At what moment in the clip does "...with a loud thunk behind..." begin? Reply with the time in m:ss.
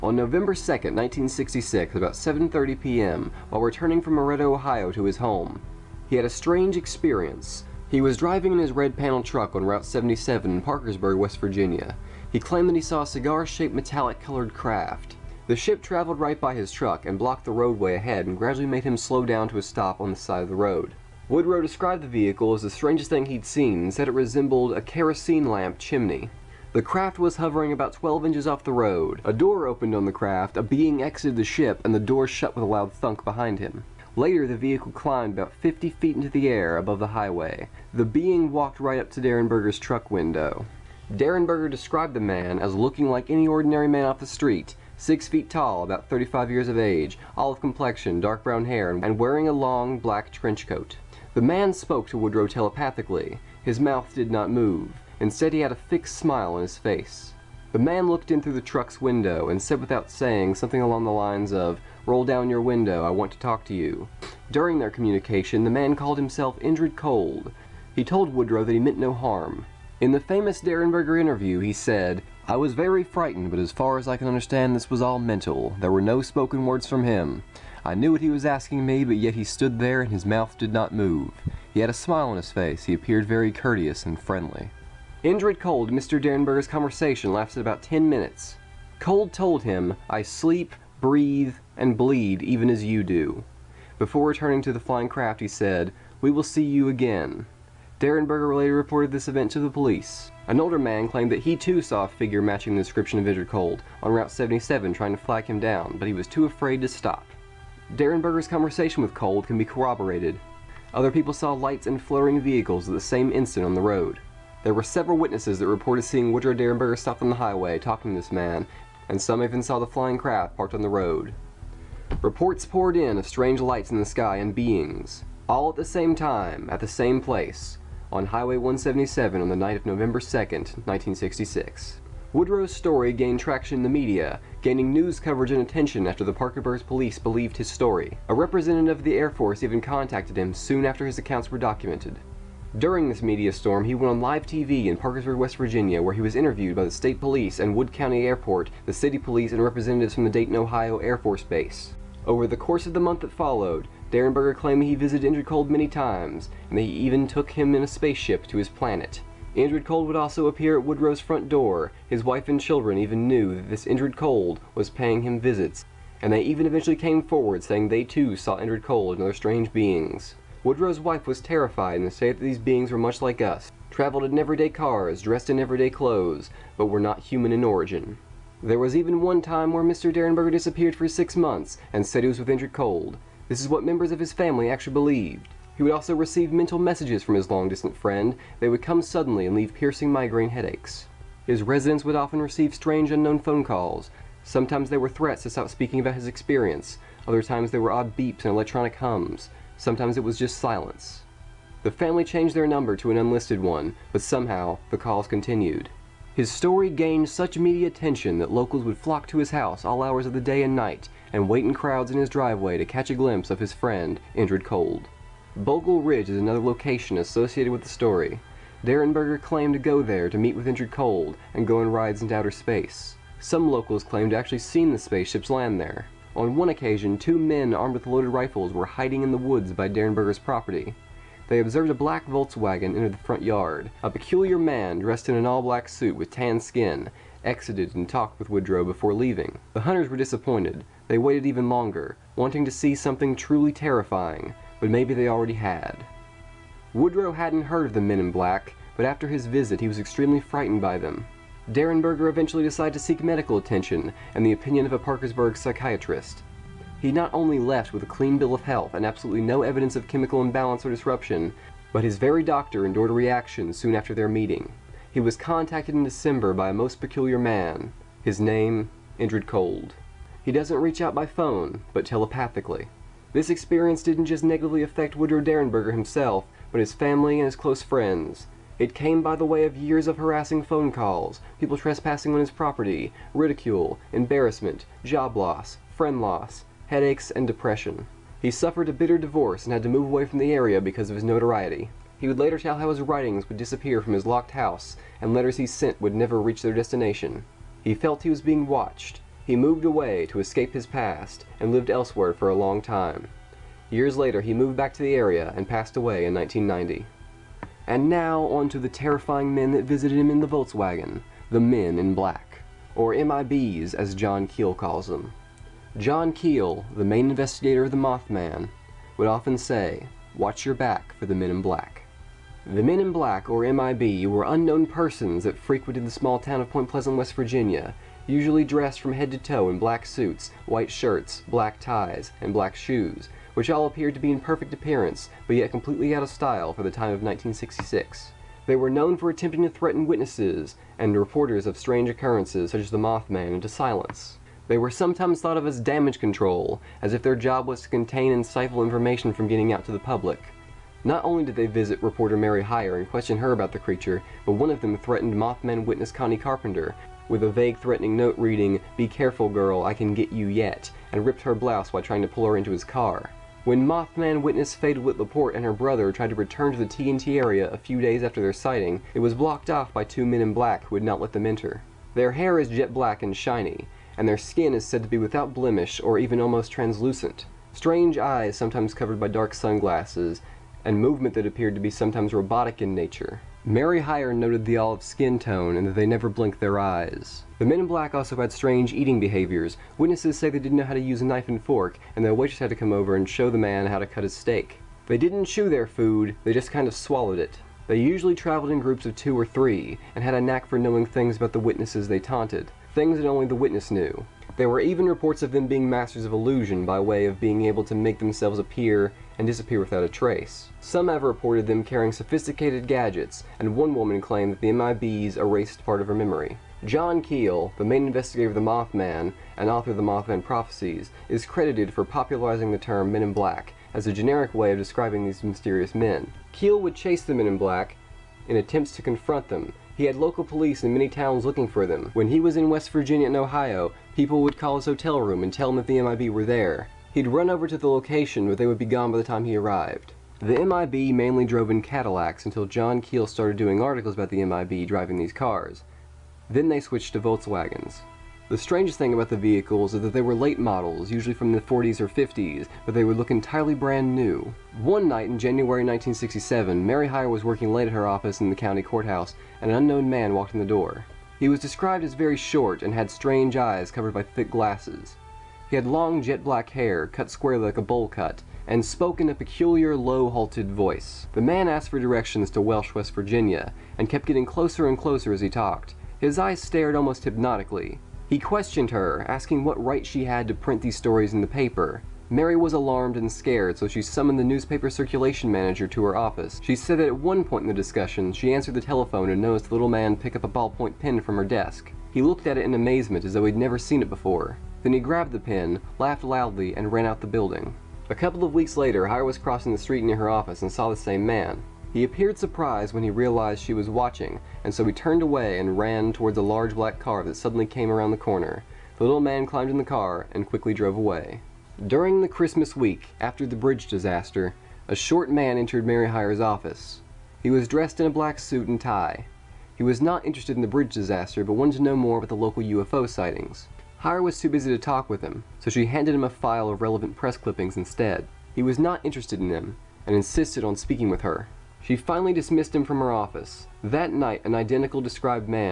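0:32.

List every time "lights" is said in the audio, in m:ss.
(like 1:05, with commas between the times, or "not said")
1:51, 2:03.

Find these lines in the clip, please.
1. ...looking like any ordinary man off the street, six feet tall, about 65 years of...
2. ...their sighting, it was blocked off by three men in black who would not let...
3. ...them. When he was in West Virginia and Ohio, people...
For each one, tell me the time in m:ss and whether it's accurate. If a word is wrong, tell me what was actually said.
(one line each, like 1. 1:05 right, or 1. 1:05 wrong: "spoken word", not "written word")
1. 0:42 wrong: "35", not "65"
2. 6:08 wrong: "two", not "three"
3. 7:11 right.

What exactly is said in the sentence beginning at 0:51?
The man spoke to Woodrow telepathically.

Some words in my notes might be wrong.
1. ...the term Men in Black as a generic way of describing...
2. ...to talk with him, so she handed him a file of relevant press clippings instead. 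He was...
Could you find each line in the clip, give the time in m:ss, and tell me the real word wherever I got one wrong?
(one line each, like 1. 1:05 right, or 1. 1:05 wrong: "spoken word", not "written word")
1. 7:02 right
2. 8:44 right.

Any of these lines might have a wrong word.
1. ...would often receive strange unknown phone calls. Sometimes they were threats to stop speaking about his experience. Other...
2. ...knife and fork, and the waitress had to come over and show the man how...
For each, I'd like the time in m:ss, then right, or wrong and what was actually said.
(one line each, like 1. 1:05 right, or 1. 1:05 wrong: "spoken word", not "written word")
1. 3:12 right
2. 6:31 right.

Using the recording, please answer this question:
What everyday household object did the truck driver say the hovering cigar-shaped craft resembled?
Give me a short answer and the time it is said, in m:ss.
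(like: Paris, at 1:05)
Kerosene lamp chimney, at 0:24.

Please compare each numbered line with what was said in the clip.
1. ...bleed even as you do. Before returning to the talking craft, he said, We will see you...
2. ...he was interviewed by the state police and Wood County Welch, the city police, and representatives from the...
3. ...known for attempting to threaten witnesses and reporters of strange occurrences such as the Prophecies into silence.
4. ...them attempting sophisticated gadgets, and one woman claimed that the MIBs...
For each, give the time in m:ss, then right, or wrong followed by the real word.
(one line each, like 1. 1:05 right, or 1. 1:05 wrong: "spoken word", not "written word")
1. 1:31 wrong: "flying", not "talking"
2. 2:26 wrong: "Airport", not "Welch"
3. 5:38 wrong: "Mothman", not "Prophecies"
4. 6:51 wrong: "carrying", not "attempting".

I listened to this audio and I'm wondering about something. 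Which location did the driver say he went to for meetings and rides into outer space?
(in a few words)
Bogle Ridge.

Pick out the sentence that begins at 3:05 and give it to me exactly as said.
He would also receive mental messages from his long-distant friend.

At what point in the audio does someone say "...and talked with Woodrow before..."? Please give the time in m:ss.
3:57.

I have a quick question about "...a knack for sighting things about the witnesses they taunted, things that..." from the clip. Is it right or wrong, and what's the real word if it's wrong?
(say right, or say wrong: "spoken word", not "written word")
wrong: "knowing", not "sighting".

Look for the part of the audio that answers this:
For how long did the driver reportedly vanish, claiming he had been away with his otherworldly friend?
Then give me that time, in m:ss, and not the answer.
3:01.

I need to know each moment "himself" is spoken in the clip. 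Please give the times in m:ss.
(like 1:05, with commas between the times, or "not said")
1:06, 4:35.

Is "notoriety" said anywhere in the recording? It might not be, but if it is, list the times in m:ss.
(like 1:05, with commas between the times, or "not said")
4:51.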